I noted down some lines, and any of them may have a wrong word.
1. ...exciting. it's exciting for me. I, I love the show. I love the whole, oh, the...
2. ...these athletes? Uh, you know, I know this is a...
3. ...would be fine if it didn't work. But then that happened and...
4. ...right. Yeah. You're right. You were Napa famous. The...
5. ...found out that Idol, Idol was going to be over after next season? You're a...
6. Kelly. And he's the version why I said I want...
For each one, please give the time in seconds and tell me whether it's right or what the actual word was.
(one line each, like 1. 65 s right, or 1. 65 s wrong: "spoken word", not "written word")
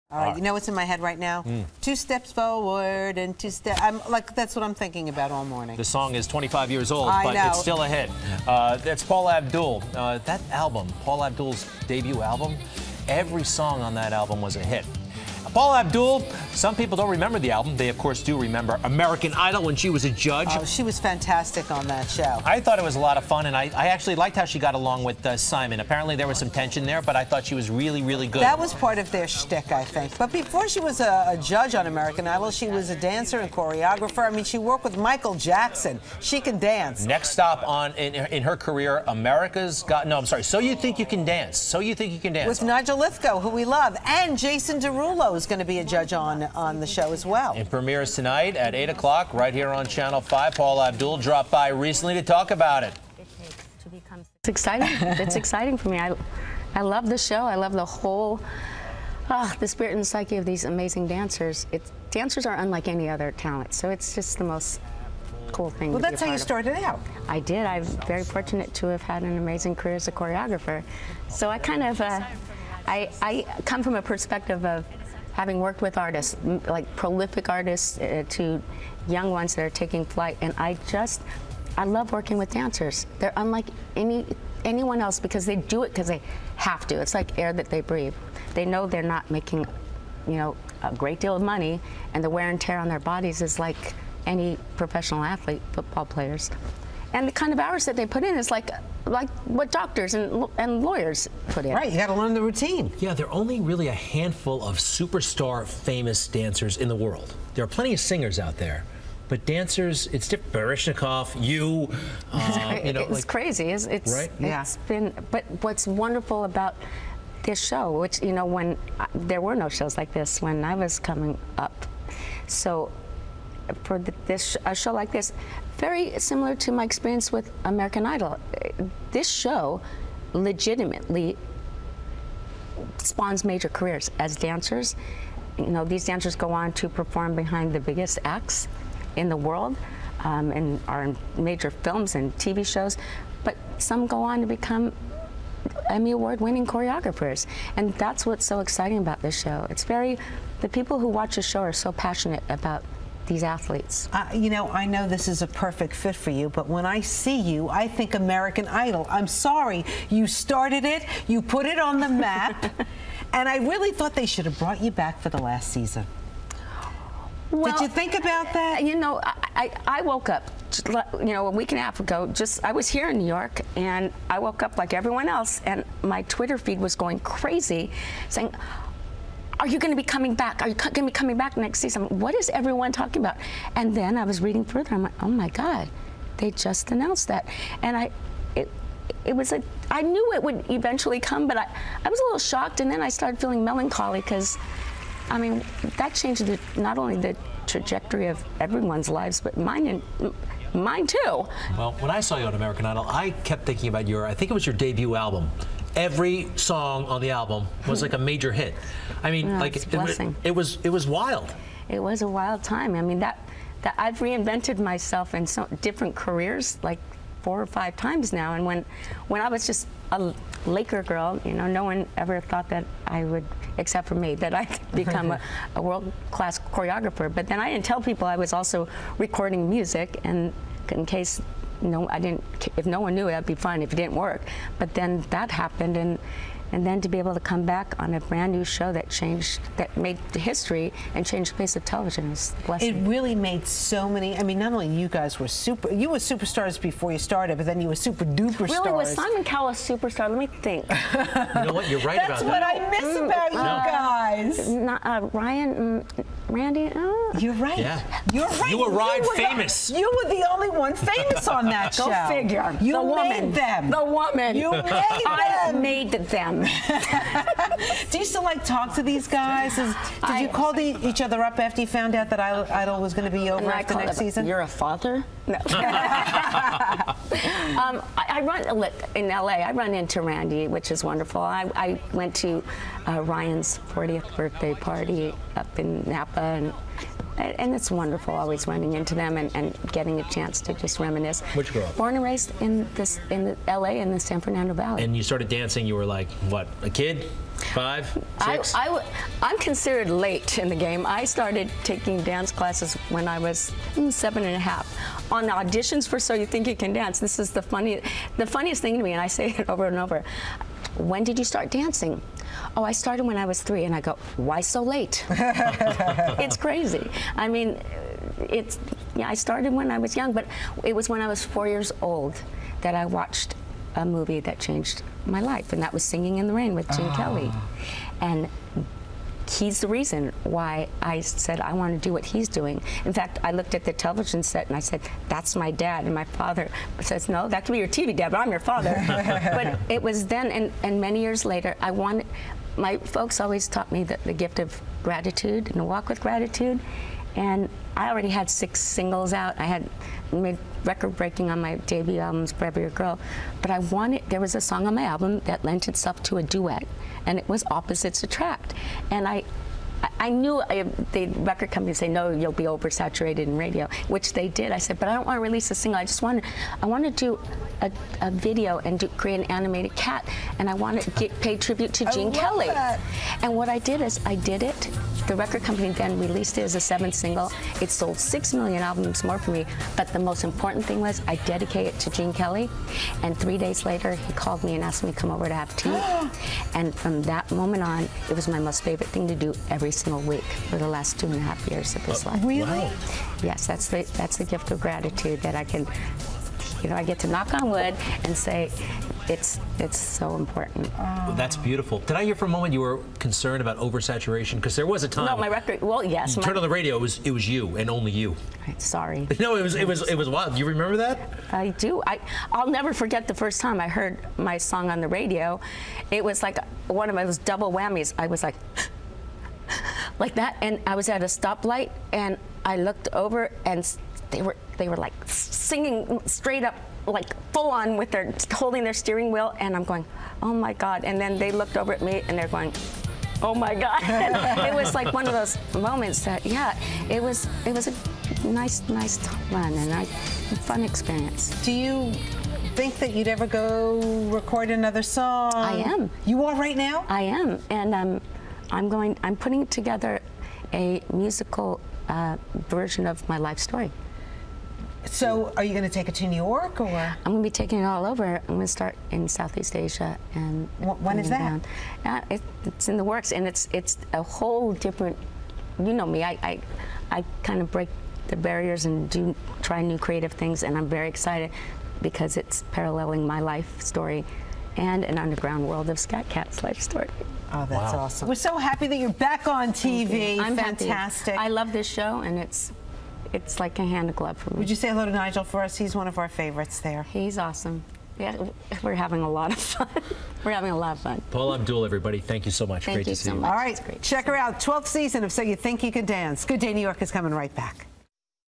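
1. 54 s right
2. 153 s right
3. 233 s right
4. 257 s wrong: "Ryan", not "Napa"
5. 271 s right
6. 327 s wrong: "reason", not "version".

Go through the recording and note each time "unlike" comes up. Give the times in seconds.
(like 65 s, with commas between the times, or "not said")
62 s, 83 s.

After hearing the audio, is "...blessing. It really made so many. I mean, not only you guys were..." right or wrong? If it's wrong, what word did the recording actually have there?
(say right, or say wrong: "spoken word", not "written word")
right.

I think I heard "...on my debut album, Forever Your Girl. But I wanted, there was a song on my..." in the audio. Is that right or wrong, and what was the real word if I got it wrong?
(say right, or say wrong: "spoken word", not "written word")
right.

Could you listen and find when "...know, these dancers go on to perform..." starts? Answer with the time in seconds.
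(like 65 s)
135 s.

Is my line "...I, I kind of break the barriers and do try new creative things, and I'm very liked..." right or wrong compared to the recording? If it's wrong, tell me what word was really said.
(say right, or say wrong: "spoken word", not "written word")
wrong: "excited", not "liked".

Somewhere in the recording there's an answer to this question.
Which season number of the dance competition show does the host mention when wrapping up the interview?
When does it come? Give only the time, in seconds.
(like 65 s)
494 s.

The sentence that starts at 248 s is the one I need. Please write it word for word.
Really, was Simon Cowell a superstar?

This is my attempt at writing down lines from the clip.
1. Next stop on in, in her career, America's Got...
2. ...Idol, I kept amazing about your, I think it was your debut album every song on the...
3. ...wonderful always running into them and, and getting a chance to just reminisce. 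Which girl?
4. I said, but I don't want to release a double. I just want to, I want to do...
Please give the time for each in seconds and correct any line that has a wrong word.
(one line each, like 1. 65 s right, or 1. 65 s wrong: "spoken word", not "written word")
1. 37 s right
2. 202 s wrong: "thinking", not "amazing"
3. 287 s right
4. 364 s wrong: "single", not "double".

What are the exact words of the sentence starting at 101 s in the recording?
Right, you got to learn the routine.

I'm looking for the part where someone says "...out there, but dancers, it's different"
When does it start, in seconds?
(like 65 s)
108 s.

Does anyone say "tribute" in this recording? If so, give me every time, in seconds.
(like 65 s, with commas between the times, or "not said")
371 s.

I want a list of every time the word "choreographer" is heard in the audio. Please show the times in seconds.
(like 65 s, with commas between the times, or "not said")
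33 s, 70 s, 146 s, 226 s.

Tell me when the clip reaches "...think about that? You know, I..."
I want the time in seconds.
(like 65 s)
167 s.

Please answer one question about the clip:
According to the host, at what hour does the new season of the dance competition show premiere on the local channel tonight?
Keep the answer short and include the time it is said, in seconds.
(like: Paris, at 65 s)
8 o'clock, at 48 s.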